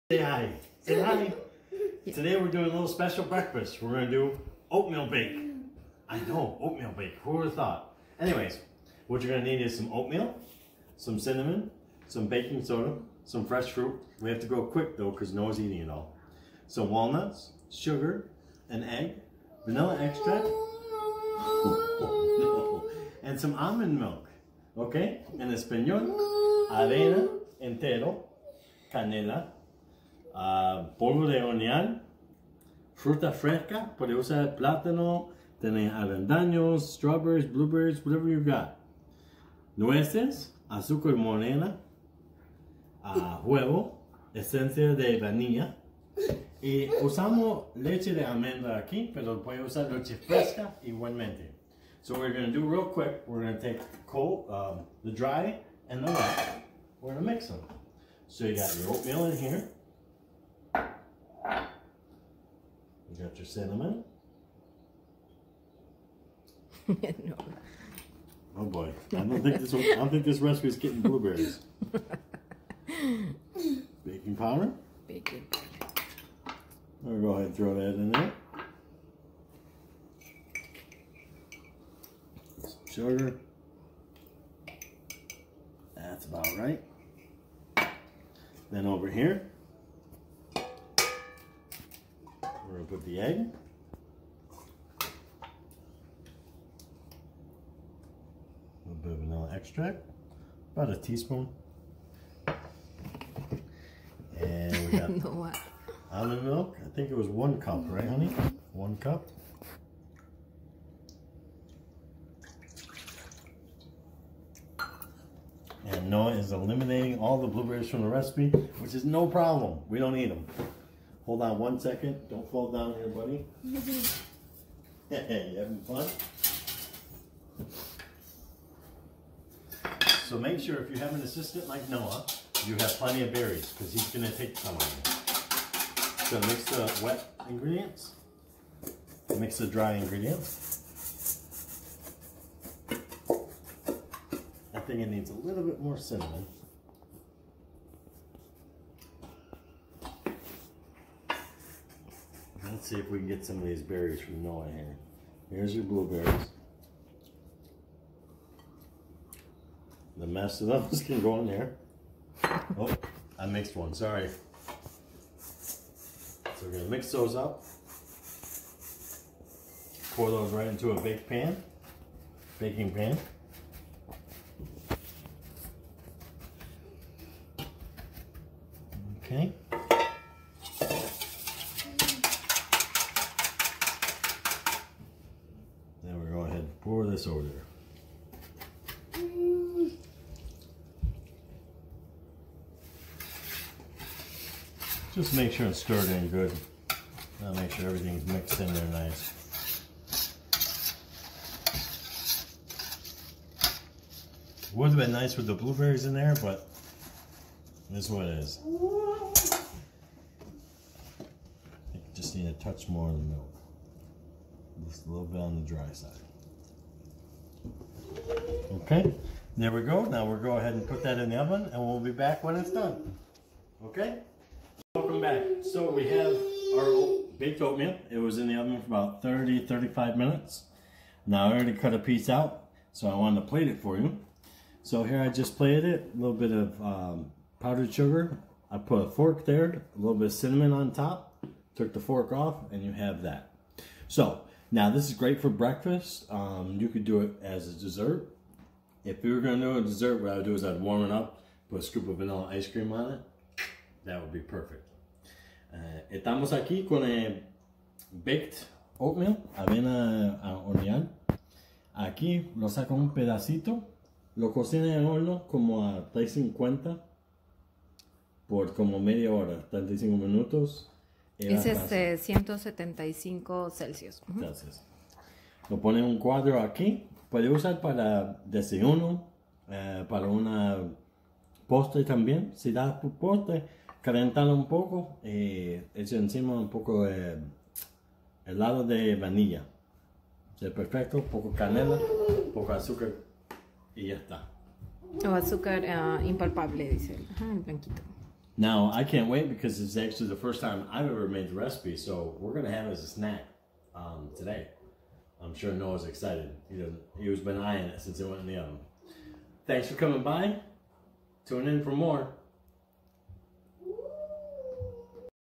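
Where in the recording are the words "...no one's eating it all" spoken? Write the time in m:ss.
0:15.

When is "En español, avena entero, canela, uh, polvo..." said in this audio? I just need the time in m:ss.
0:25.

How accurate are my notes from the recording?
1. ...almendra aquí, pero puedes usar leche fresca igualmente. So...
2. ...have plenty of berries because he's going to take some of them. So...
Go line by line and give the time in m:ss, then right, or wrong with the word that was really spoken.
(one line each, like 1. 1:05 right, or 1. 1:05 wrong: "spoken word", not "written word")
1. 0:48 right
2. 2:12 right.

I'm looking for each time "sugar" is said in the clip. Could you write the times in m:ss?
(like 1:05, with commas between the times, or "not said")
0:17, 1:22, 3:57.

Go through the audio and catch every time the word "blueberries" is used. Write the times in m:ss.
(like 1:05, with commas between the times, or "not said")
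0:37, 1:11, 1:57, 2:35, 3:25.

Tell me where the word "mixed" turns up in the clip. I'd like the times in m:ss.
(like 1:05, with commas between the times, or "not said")
2:43, 3:18.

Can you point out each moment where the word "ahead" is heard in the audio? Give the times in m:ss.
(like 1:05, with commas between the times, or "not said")
1:17, 3:40.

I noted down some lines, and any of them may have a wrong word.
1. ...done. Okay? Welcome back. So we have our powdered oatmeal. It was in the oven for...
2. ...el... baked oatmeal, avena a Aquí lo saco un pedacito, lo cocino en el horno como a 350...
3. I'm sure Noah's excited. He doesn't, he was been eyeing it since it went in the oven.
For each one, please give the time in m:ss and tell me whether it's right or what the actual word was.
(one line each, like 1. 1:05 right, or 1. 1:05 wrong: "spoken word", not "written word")
1. 3:42 wrong: "baked", not "powdered"
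2. 4:17 right
3. 5:05 right.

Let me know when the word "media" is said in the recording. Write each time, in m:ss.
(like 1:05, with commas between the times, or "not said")
4:28.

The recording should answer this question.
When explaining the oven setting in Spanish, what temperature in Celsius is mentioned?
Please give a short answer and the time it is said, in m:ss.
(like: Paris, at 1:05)
175 Celsius, at 4:32.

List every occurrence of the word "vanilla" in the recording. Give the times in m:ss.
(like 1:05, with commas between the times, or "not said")
0:19, 1:39, 4:12.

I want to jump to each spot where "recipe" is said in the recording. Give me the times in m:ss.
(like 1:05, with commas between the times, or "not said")
1:58, 5:01.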